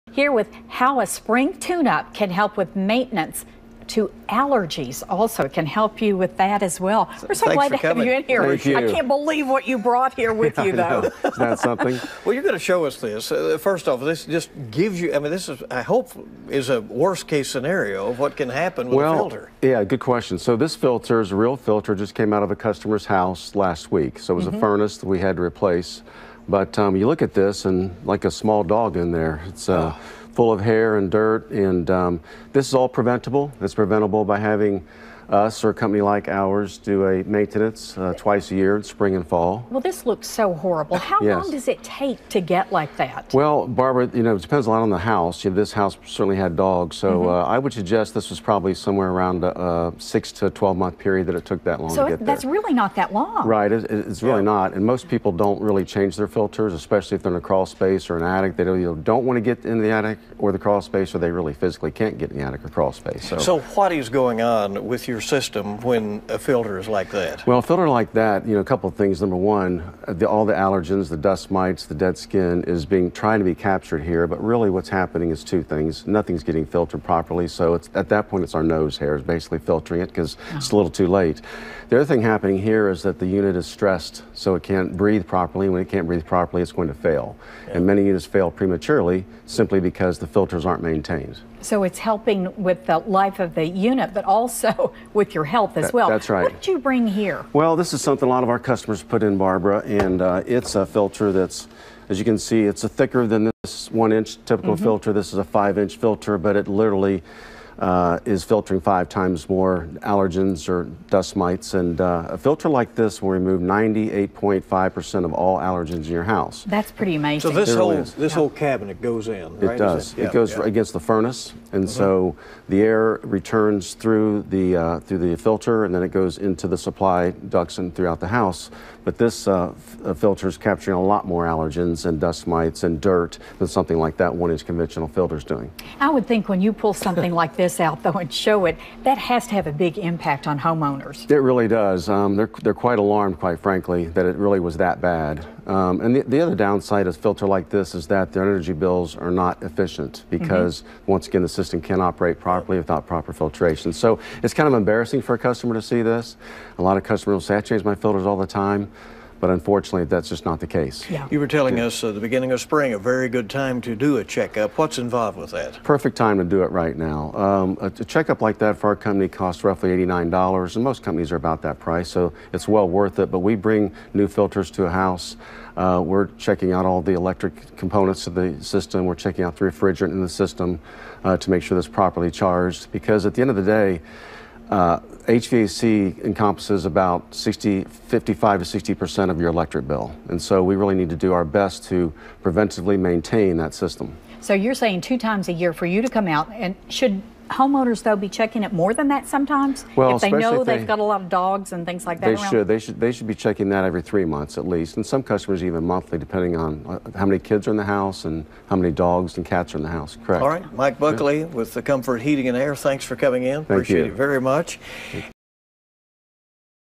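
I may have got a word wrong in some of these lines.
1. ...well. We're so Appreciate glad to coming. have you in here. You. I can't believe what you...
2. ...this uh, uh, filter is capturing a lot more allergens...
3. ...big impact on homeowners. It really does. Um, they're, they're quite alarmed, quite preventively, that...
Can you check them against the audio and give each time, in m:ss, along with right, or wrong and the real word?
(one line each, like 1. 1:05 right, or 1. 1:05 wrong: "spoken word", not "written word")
1. 0:06 wrong: "Thanks", not "Appreciate"
2. 2:09 right
3. 2:19 wrong: "frankly", not "preventively".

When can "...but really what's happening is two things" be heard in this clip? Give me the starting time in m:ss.
1:14.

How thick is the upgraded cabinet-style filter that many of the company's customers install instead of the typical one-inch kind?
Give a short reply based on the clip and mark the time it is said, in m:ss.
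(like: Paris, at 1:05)
5 inches, at 1:45.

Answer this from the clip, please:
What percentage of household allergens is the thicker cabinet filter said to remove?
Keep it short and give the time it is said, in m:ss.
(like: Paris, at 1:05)
98.5%, at 1:53.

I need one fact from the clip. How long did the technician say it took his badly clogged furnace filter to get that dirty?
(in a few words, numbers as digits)
6 to 12 months.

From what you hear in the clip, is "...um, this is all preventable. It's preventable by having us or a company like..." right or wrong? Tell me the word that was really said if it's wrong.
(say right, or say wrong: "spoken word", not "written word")
right.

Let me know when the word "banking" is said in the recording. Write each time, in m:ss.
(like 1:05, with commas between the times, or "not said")
not said.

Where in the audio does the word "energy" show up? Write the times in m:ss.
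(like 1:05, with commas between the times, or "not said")
2:28.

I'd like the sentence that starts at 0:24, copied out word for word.
furnace that we had to replace.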